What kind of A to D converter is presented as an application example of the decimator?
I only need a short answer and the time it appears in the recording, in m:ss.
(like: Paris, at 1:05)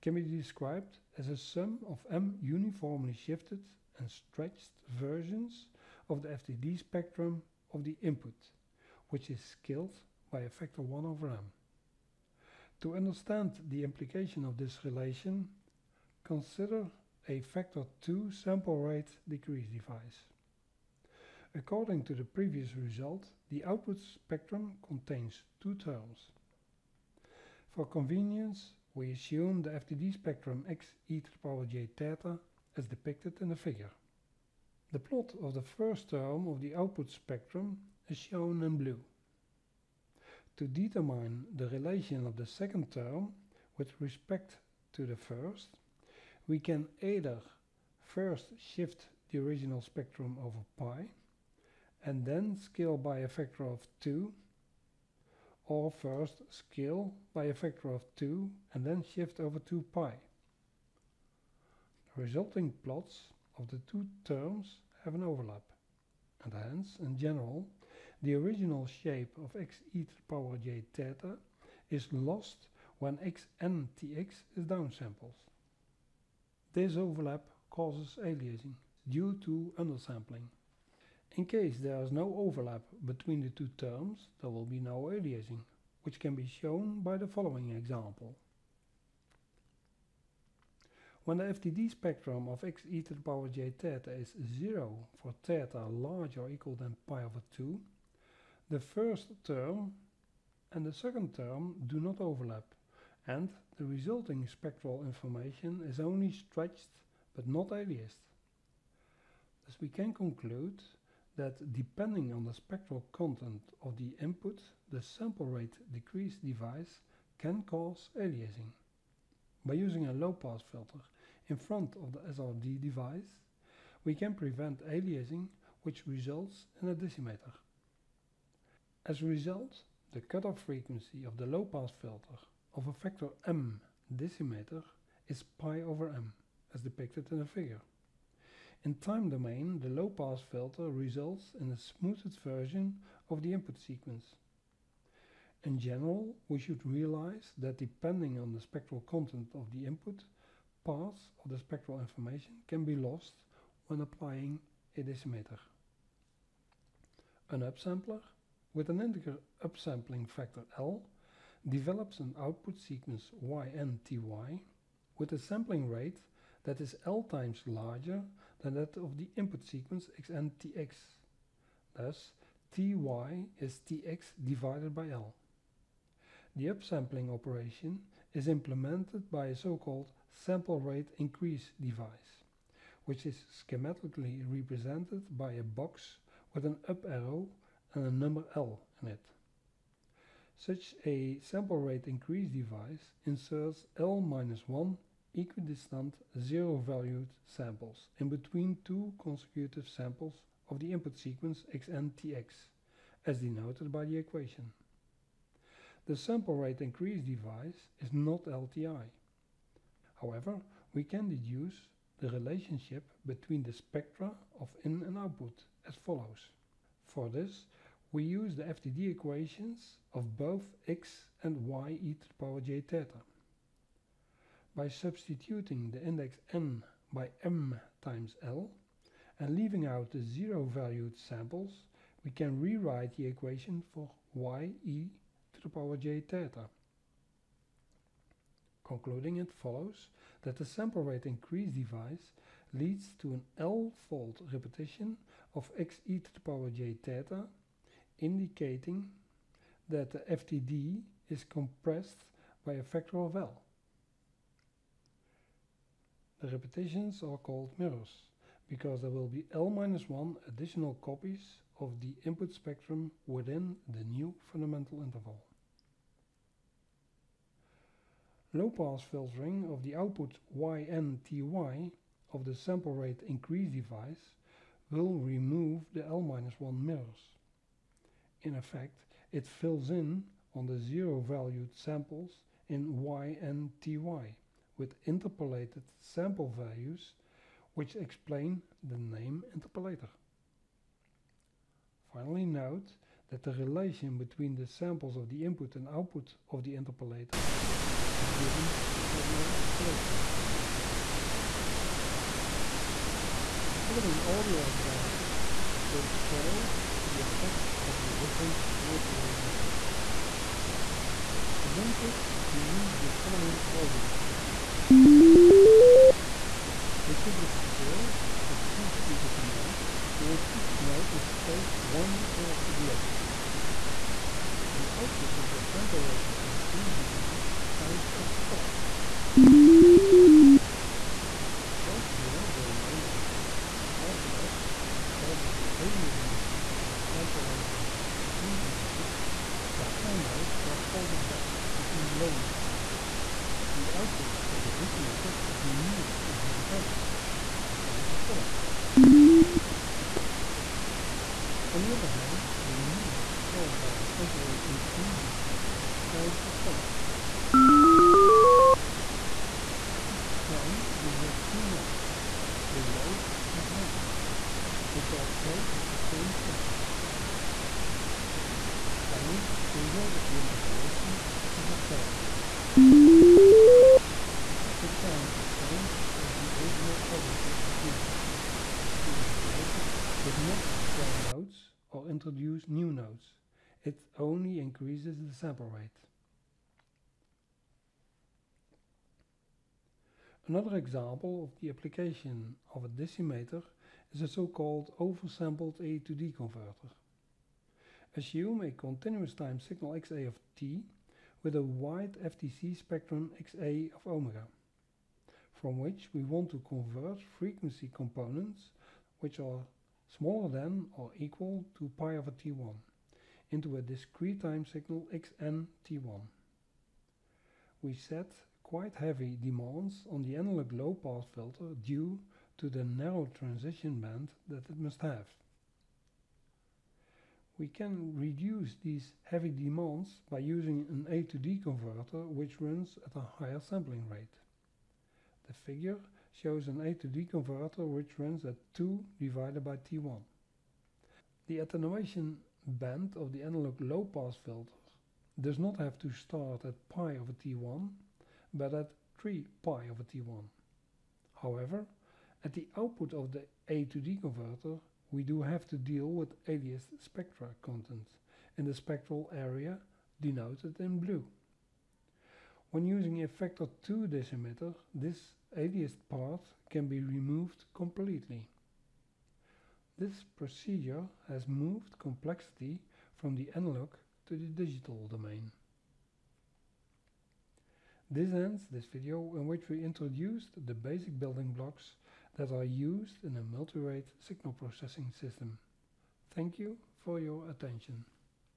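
oversampled, at 6:34.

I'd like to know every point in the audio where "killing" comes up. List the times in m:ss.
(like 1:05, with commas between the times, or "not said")
not said.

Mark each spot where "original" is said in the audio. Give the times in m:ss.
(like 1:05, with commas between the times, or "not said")
0:49, 1:08, 6:16.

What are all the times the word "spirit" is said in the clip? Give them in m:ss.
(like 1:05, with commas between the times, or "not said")
not said.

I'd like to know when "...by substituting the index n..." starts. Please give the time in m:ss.
3:44.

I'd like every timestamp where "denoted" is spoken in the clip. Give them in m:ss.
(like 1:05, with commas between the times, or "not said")
3:23, 7:40.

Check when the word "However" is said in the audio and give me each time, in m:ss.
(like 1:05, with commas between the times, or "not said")
3:30, 7:31.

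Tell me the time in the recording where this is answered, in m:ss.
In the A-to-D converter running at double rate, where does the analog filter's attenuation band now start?
7:29.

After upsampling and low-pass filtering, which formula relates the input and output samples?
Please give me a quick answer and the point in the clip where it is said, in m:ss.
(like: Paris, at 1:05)
interpolation formula, at 4:59.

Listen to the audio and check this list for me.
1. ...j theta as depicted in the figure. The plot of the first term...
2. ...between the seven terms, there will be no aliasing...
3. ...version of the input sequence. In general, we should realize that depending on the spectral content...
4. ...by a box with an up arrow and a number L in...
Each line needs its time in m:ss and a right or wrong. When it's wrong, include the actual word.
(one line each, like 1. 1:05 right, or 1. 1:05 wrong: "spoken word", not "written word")
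1. 0:31 right
2. 1:23 wrong: "two", not "seven"
3. 2:22 right
4. 3:05 right.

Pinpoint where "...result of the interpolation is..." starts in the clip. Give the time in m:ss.
6:09.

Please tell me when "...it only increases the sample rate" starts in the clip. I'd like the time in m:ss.
6:23.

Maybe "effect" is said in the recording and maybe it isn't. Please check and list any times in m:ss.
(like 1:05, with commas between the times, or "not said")
4:38, 5:07, 5:36.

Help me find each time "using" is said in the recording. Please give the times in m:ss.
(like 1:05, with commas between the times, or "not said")
1:59, 7:10, 7:42.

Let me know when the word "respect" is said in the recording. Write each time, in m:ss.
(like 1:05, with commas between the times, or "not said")
0:43.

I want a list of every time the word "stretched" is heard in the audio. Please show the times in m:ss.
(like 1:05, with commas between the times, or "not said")
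0:04, 1:46.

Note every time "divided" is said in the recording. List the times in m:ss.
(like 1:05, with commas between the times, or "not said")
2:54, 7:19.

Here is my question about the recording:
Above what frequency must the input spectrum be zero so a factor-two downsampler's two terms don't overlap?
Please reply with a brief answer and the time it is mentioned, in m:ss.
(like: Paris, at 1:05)
pi/2, at 1:37.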